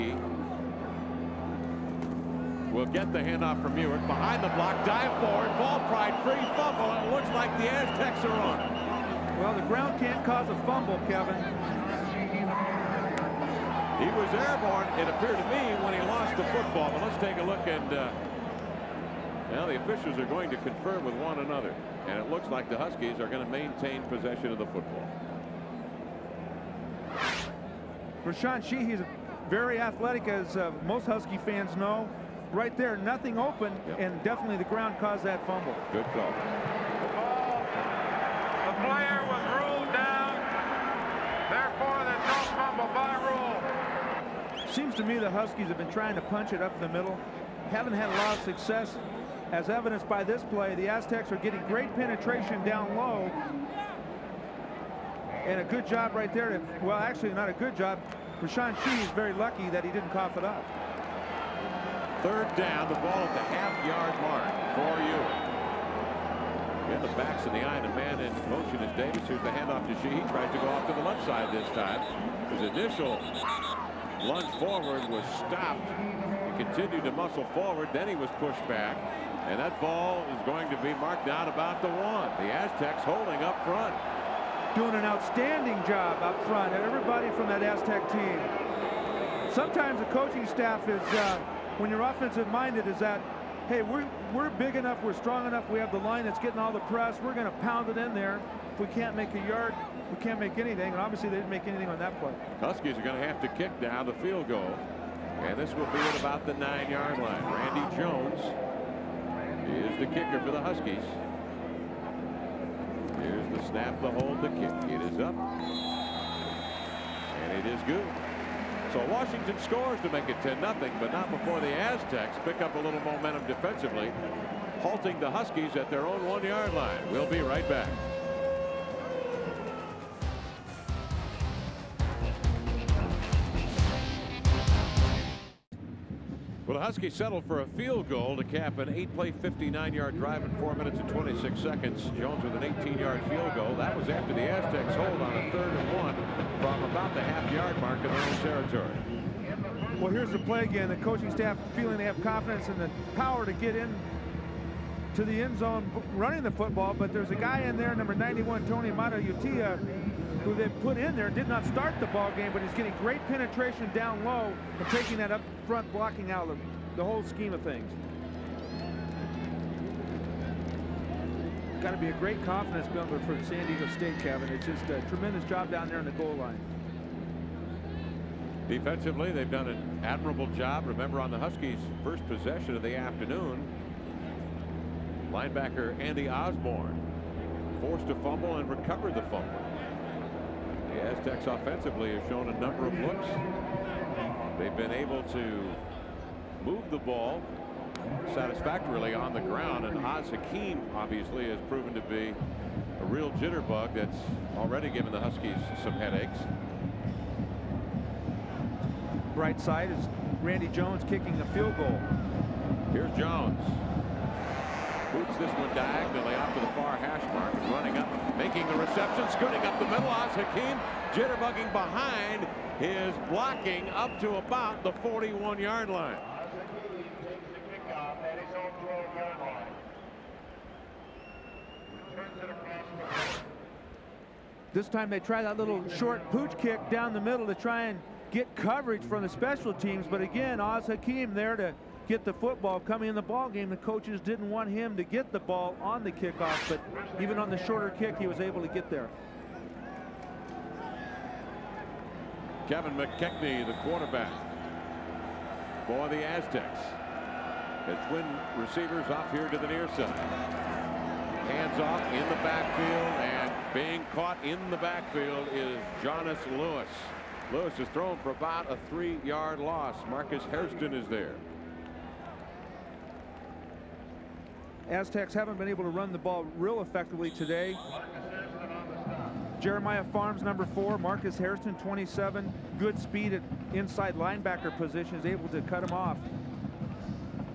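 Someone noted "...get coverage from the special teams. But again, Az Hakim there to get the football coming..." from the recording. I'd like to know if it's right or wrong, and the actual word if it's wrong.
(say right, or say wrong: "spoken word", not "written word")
right.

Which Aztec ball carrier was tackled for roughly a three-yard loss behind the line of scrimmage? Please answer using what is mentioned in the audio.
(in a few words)
Jonas Lewis.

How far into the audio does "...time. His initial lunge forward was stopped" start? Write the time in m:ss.
1:11.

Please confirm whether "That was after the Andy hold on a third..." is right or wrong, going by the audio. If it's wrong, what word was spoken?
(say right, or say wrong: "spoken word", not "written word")
wrong: "Aztecs", not "Andy".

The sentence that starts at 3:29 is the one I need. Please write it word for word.
Bright side is Randy Jones kicking the field goal.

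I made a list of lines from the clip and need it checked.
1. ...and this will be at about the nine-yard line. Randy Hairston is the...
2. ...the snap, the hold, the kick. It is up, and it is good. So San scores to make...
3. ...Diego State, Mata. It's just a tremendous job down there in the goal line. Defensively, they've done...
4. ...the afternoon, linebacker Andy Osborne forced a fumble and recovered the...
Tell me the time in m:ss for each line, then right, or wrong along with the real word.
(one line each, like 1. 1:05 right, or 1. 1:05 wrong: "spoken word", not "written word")
1. 1:45 wrong: "Jones", not "Hairston"
2. 1:53 wrong: "Washington", not "San"
3. 2:53 wrong: "Kevin", not "Mata"
4. 3:02 right.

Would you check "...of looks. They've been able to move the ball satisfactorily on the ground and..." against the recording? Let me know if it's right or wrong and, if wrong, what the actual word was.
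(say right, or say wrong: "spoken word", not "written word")
right.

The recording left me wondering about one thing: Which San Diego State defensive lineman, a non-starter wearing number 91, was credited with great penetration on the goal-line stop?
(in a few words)
Tony Mata Utia.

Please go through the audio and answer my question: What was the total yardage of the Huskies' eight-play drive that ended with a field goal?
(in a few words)
59 yards.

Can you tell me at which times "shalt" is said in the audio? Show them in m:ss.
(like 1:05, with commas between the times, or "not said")
not said.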